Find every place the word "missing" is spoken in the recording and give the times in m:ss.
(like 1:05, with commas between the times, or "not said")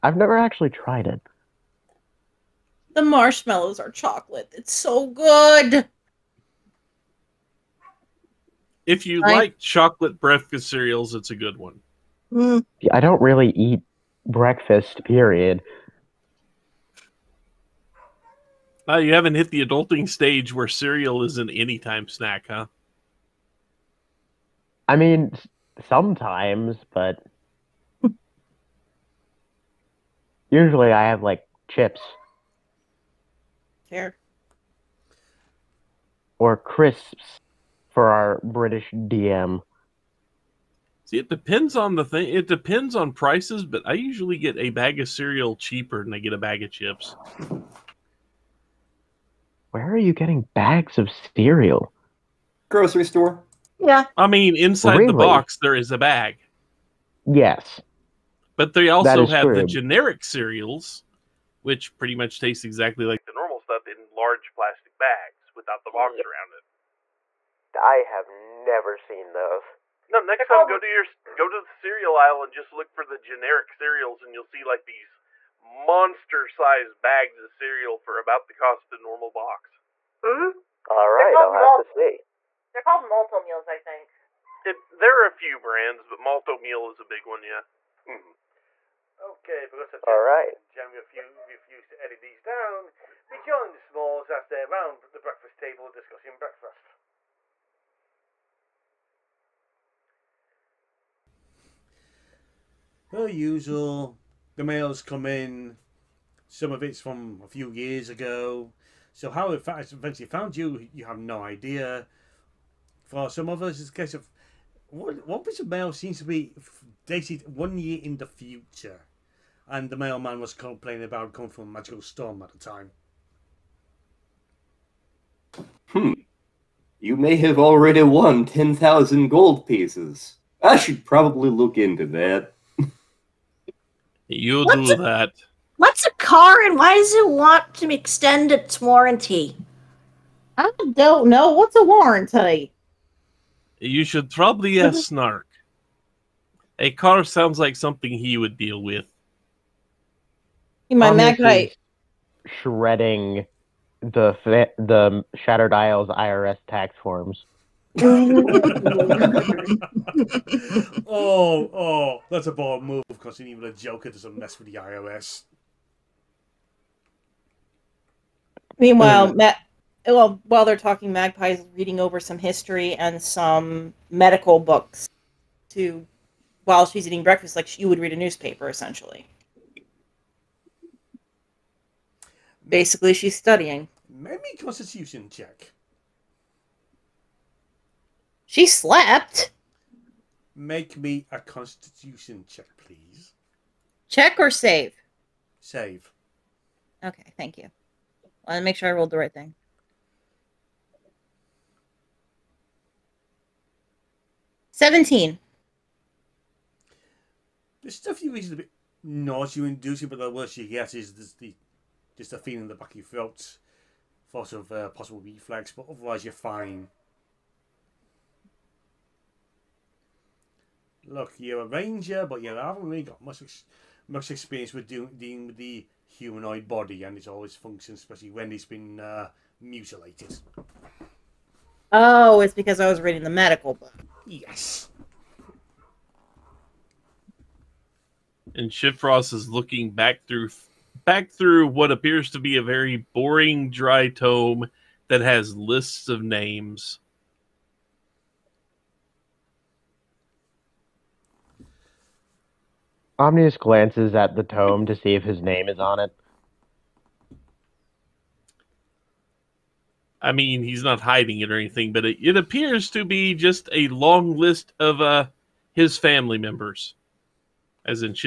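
not said.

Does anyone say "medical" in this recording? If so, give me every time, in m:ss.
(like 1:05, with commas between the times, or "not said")
2:54, 3:53.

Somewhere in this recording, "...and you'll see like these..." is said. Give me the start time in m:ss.
1:14.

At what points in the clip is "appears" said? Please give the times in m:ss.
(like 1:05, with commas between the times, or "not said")
4:01, 4:22.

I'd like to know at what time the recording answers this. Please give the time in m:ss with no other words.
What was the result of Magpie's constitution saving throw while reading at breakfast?
3:24.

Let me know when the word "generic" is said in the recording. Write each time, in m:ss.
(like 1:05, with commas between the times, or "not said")
0:59, 1:13.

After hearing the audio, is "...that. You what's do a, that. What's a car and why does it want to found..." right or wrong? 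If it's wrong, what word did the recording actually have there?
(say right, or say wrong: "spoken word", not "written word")
wrong: "extend", not "found".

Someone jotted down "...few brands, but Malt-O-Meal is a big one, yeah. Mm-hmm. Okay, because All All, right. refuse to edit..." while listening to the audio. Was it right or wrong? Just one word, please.
wrong.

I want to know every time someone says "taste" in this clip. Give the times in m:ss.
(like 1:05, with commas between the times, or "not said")
1:02.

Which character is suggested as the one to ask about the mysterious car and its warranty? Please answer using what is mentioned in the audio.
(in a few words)
Snark.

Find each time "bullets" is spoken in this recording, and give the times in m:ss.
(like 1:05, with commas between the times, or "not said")
not said.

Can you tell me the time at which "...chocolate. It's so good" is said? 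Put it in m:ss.
0:03.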